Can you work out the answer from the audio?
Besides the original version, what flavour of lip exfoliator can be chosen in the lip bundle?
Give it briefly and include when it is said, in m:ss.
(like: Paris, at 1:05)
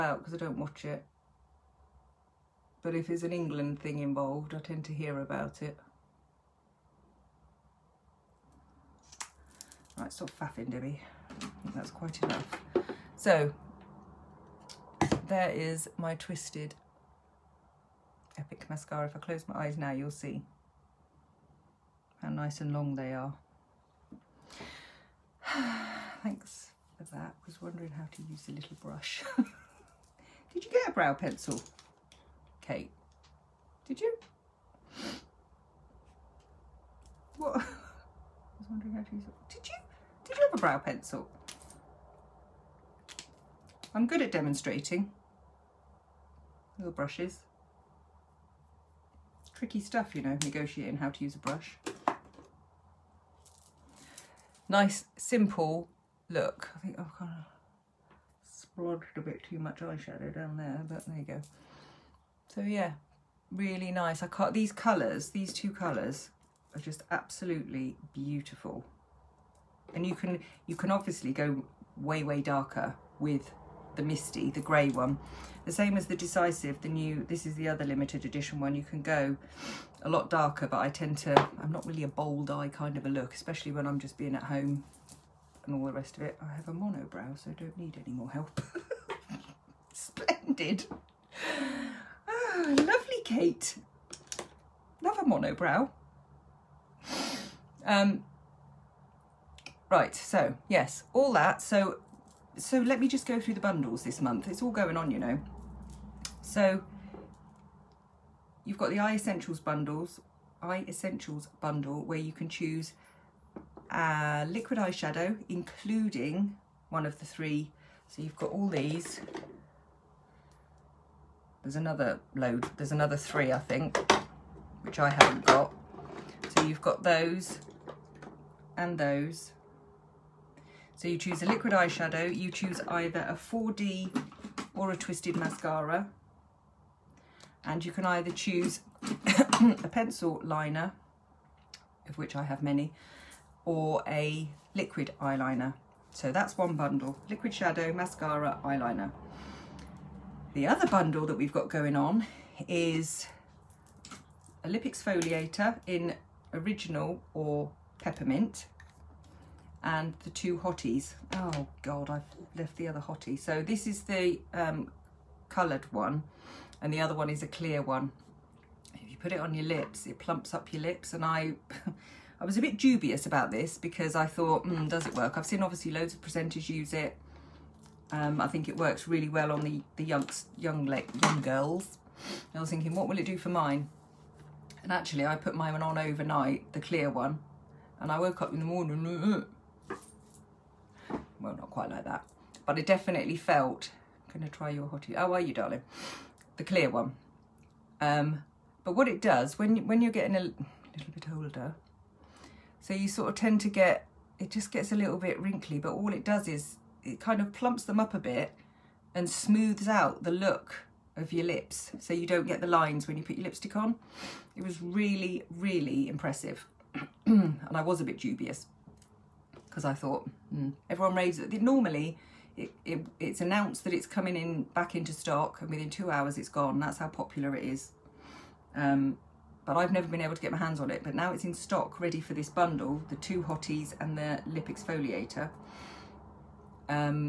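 Peppermint, at 2:37.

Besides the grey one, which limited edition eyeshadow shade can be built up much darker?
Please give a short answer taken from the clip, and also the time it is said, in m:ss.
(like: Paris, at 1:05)
Decisive, at 1:16.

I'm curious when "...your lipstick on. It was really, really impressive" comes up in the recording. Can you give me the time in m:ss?
3:33.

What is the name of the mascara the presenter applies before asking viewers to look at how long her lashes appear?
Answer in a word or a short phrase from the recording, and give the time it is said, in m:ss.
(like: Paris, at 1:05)
Twisted Epic, at 0:16.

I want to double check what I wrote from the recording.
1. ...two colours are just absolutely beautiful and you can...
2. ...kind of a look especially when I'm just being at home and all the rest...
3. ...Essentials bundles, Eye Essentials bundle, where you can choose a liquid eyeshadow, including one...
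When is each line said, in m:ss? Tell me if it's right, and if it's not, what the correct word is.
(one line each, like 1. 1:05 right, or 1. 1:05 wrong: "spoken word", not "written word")
1. 1:05 right
2. 1:22 right
3. 1:49 right.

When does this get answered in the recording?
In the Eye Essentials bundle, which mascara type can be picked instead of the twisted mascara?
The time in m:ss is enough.
2:13.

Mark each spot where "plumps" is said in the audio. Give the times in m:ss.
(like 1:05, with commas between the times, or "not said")
2:50, 3:27.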